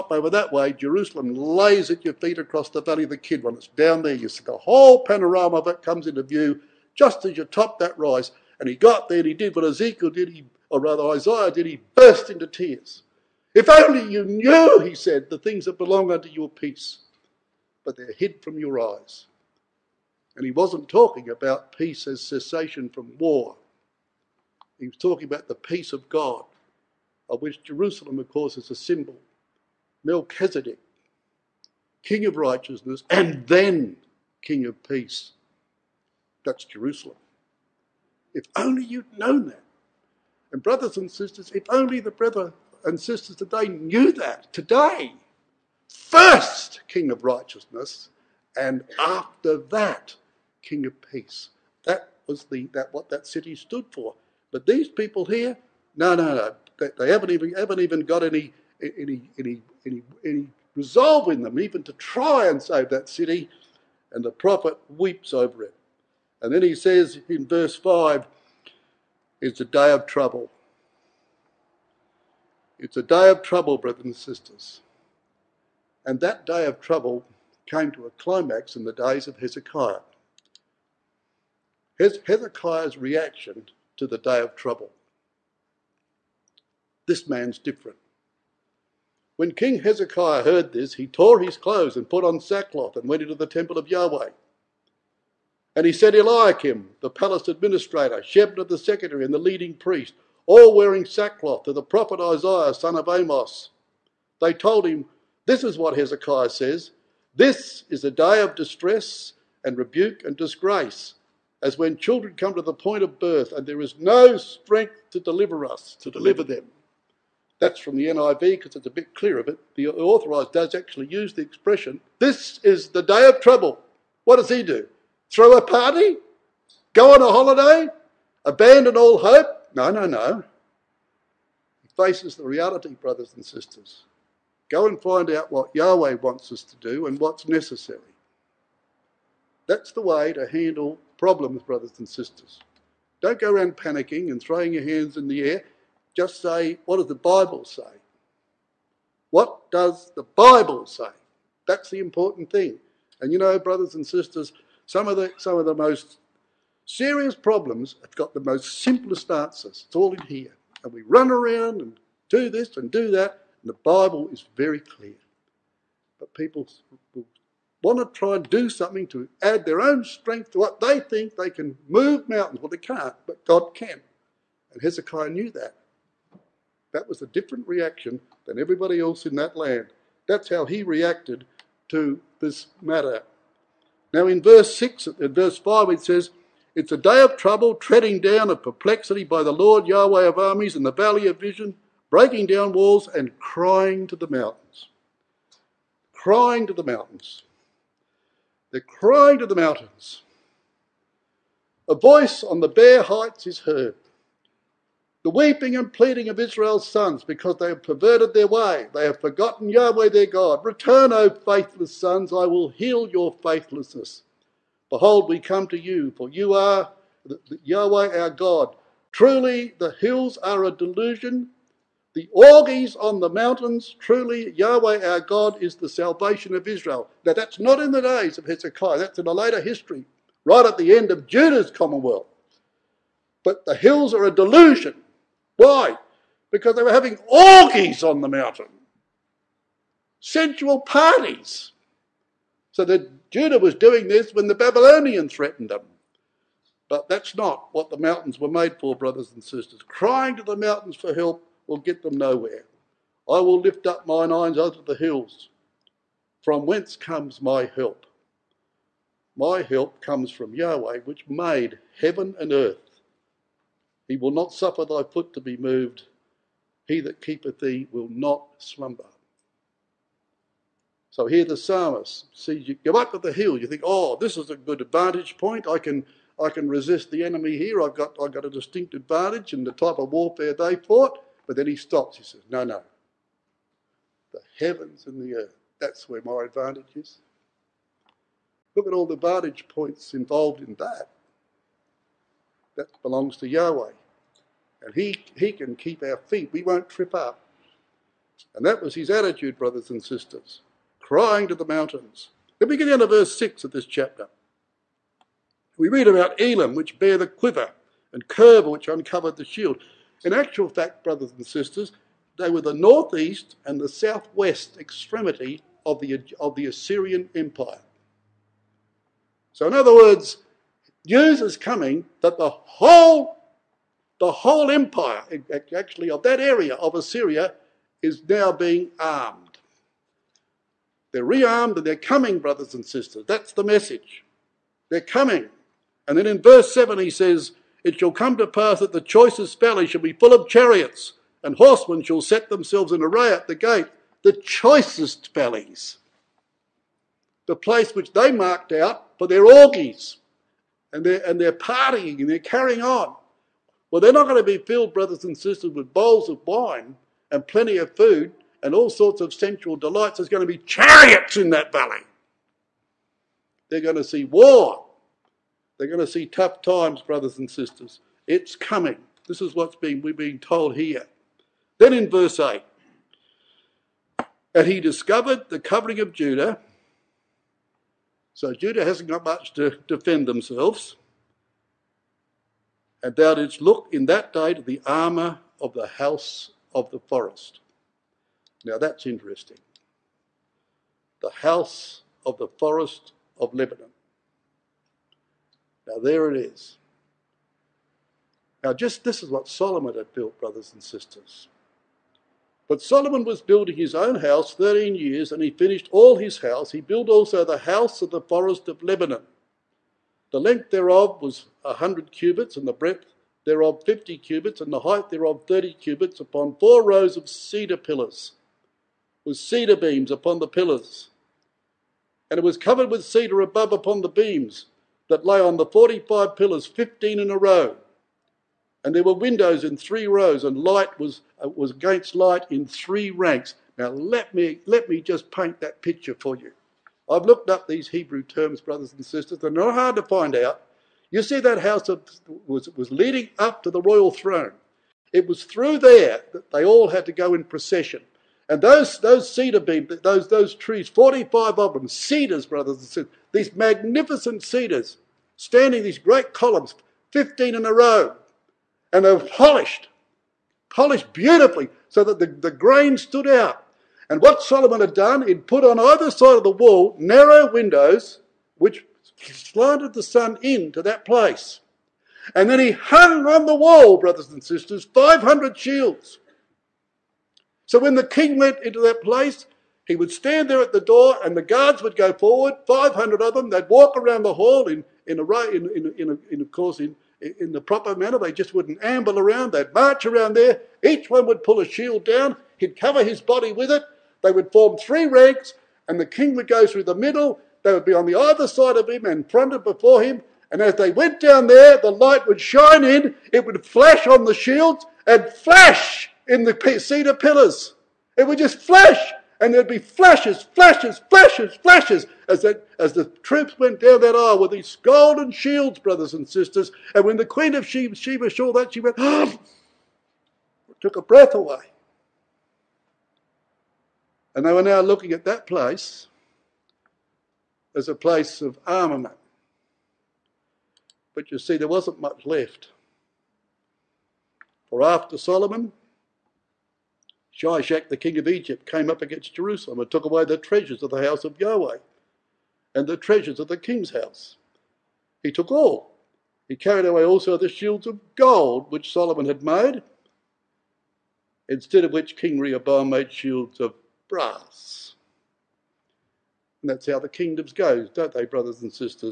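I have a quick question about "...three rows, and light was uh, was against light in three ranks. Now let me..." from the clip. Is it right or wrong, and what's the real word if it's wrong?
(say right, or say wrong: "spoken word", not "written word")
right.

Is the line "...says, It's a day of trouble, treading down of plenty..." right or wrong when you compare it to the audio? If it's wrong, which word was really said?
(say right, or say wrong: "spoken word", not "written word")
wrong: "perplexity", not "plenty".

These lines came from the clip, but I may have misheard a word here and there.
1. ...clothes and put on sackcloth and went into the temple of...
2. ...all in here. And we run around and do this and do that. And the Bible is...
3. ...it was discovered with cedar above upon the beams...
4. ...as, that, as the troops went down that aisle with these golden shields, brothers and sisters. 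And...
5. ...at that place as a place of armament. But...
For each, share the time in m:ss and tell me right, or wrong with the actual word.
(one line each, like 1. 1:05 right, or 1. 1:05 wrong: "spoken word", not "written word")
1. 1:31 right
2. 2:39 right
3. 7:02 wrong: "covered", not "discovered"
4. 8:32 right
5. 8:45 right.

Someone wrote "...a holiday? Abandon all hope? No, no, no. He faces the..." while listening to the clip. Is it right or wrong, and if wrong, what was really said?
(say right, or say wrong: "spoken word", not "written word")
right.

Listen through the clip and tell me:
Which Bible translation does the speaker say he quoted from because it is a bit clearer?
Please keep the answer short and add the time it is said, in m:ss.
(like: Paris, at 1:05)
NIV, at 1:58.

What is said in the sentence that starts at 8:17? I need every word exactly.
They would be on the either side of him and fronted before him.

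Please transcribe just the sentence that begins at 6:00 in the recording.
There's going to be chariots in that valley.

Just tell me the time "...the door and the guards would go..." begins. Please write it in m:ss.
8:00.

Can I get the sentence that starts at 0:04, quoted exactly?
You see the whole panorama of it comes into view just as you top that rise.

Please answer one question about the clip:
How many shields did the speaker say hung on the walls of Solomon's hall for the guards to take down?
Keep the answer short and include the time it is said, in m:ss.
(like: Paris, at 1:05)
500, at 7:54.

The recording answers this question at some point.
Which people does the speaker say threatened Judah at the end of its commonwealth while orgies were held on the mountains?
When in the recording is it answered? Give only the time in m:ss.
4:04.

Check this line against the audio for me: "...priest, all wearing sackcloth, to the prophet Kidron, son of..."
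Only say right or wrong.
wrong.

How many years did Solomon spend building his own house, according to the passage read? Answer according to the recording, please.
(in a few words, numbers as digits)
13.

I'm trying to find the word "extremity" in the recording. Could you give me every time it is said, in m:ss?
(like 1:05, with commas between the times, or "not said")
5:14.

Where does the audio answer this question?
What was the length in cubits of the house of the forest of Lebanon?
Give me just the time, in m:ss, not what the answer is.
6:51.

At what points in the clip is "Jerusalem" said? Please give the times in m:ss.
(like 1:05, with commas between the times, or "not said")
0:00, 0:27, 0:36, 8:59.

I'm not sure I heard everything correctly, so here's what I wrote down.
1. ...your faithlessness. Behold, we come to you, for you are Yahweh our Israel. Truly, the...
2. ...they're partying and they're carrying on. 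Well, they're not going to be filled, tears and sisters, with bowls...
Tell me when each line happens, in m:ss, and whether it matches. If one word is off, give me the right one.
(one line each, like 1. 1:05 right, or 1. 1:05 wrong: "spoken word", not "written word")
1. 3:33 wrong: "God", not "Israel"
2. 5:51 wrong: "brothers", not "tears".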